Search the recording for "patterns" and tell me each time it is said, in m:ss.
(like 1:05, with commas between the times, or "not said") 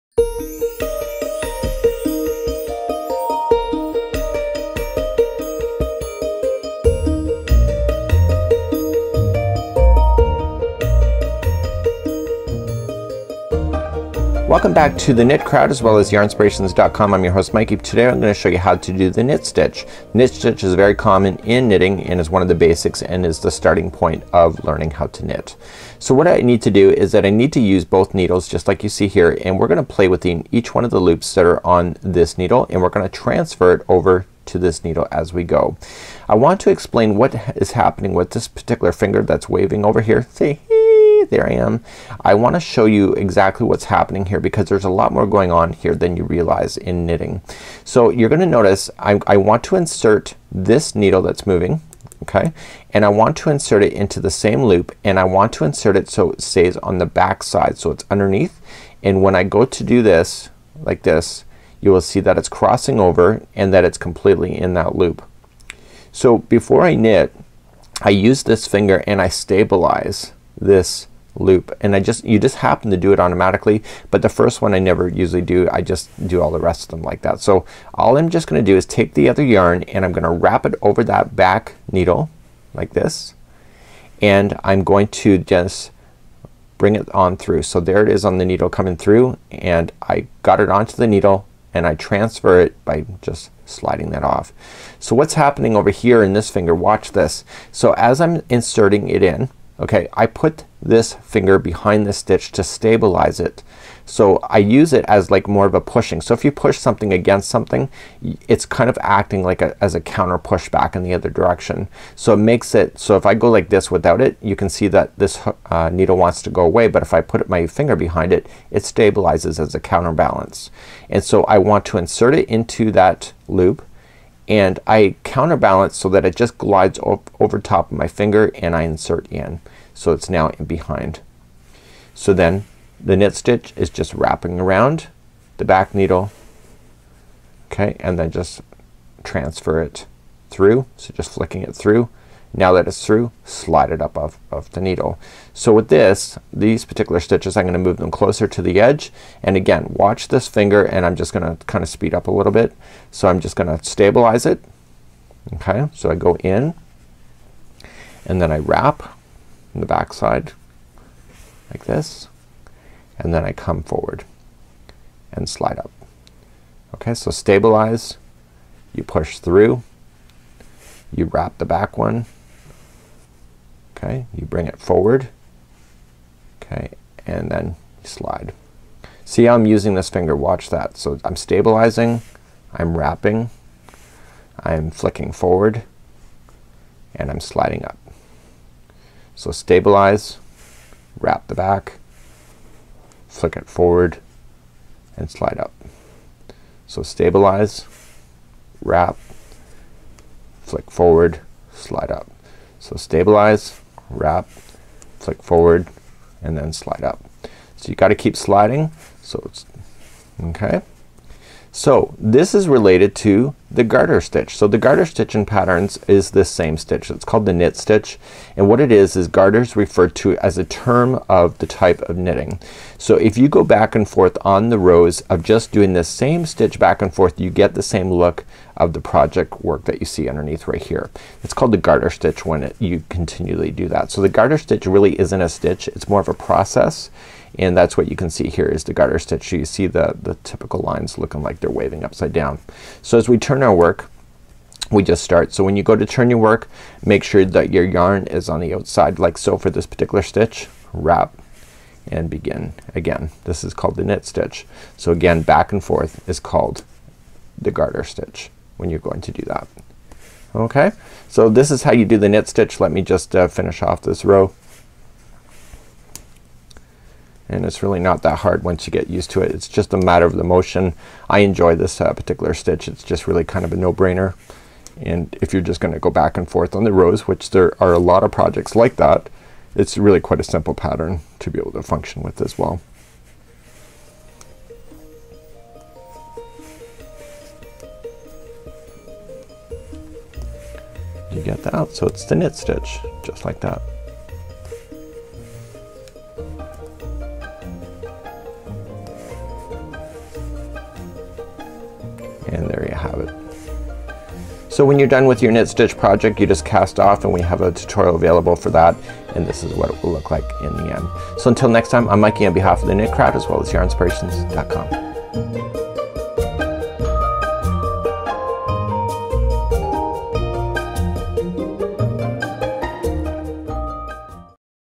3:35, 4:40.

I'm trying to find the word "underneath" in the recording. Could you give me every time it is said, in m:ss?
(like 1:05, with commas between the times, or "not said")
0:58, 3:50.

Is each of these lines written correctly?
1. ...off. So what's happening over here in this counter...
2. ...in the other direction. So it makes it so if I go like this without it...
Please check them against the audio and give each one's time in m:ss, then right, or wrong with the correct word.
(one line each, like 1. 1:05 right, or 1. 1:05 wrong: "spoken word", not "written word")
1. 1:34 wrong: "finger", not "counter"
2. 1:50 right.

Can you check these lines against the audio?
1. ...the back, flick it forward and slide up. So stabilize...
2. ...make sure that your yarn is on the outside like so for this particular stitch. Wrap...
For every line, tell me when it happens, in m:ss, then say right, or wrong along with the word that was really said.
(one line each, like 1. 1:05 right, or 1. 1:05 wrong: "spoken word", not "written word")
1. 3:11 right
2. 4:07 right.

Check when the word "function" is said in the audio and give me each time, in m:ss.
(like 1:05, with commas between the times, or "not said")
4:41.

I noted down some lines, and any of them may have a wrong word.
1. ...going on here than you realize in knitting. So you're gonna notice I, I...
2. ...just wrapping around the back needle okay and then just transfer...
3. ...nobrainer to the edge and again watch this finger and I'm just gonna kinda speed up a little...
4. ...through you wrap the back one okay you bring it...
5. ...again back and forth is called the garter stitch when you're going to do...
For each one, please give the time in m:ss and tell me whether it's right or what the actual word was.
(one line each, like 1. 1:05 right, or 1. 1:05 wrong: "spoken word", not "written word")
1. 0:45 right
2. 2:13 right
3. 2:28 wrong: "closer", not "nobrainer"
4. 2:49 right
5. 4:15 right.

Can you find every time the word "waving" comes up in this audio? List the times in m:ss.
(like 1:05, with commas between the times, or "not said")
0:39, 4:01.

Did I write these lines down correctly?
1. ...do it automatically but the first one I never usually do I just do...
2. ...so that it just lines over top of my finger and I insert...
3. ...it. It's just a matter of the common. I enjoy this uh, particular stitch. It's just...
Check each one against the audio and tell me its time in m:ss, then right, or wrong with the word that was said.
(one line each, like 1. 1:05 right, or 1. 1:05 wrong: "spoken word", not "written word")
1. 1:12 right
2. 2:05 wrong: "glides", not "lines"
3. 4:29 wrong: "motion", not "common".